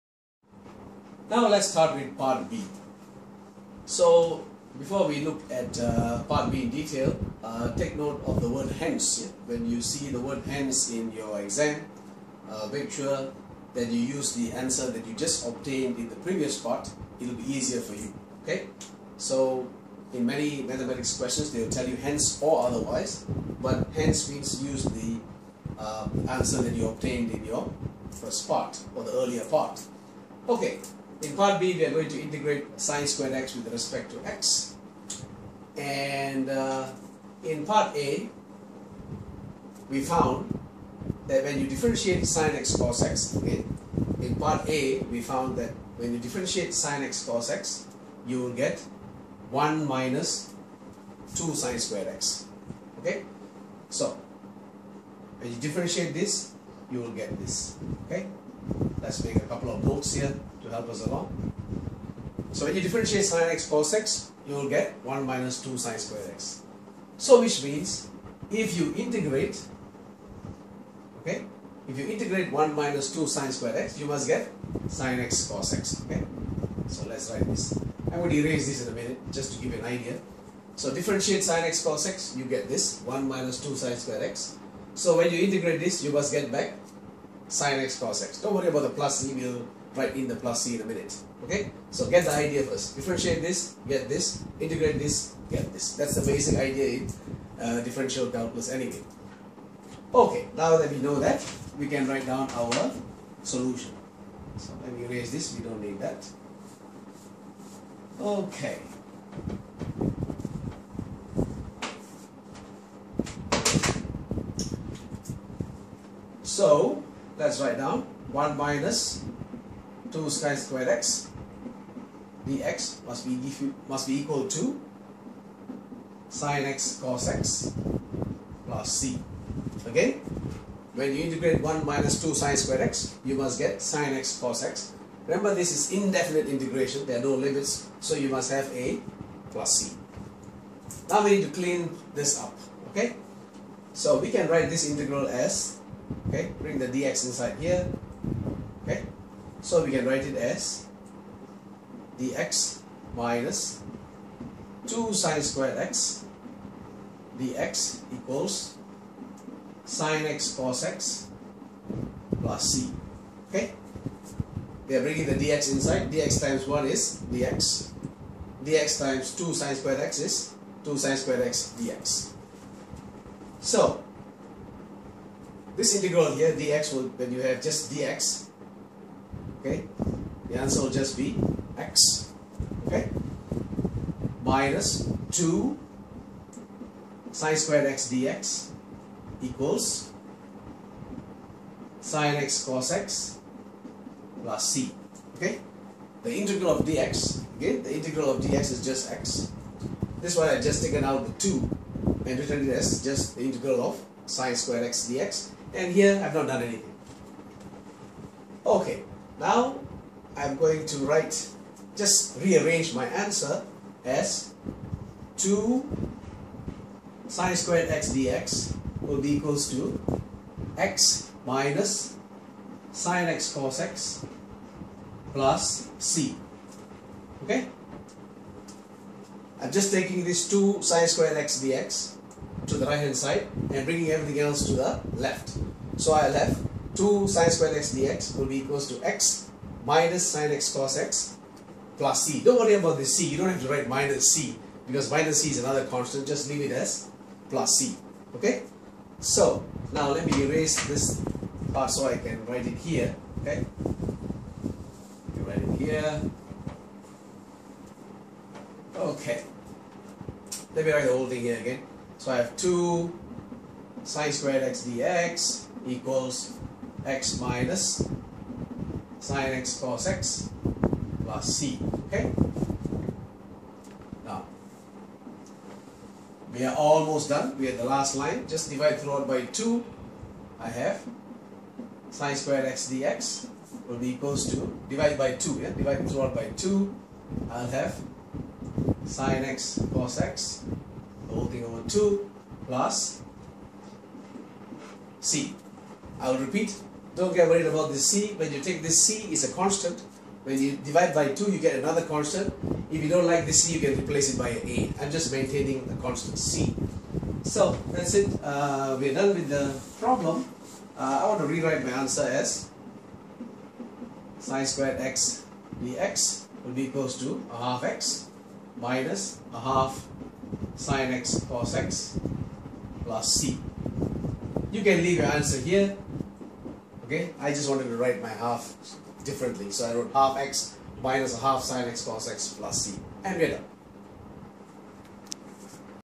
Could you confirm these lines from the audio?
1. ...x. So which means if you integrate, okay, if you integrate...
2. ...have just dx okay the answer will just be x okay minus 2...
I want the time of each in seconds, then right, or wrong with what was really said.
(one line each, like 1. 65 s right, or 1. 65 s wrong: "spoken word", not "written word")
1. 66 s right
2. 177 s right.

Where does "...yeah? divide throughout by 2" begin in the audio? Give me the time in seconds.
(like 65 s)
285 s.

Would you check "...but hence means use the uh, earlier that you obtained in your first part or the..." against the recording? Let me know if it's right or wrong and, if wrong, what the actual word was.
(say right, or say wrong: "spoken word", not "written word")
wrong: "answer", not "earlier".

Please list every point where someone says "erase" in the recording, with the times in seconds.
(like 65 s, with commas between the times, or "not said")
78 s, 105 s, 250 s.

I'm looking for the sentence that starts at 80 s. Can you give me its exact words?
So differentiate sine x cos x, you get this 1 minus 2 sine squared x.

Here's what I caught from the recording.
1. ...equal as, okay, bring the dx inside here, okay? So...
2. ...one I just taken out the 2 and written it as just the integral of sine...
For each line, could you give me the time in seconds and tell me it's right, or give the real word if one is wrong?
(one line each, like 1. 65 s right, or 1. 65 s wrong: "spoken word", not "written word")
1. 144 s wrong: "integral", not "equal"
2. 200 s right.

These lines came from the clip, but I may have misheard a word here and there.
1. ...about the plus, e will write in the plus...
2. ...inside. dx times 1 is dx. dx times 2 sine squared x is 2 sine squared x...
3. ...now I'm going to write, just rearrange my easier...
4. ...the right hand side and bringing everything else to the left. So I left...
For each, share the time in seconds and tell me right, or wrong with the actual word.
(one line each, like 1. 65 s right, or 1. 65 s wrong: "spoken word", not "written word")
1. 88 s right
2. 165 s right
3. 209 s wrong: "answer", not "easier"
4. 232 s right.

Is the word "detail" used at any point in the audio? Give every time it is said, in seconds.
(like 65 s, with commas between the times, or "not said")
6 s.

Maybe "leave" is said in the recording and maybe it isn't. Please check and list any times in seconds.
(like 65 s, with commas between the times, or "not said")
246 s, 325 s.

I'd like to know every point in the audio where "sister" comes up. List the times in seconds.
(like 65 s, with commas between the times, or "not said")
not said.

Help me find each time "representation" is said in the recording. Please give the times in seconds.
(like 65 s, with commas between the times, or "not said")
not said.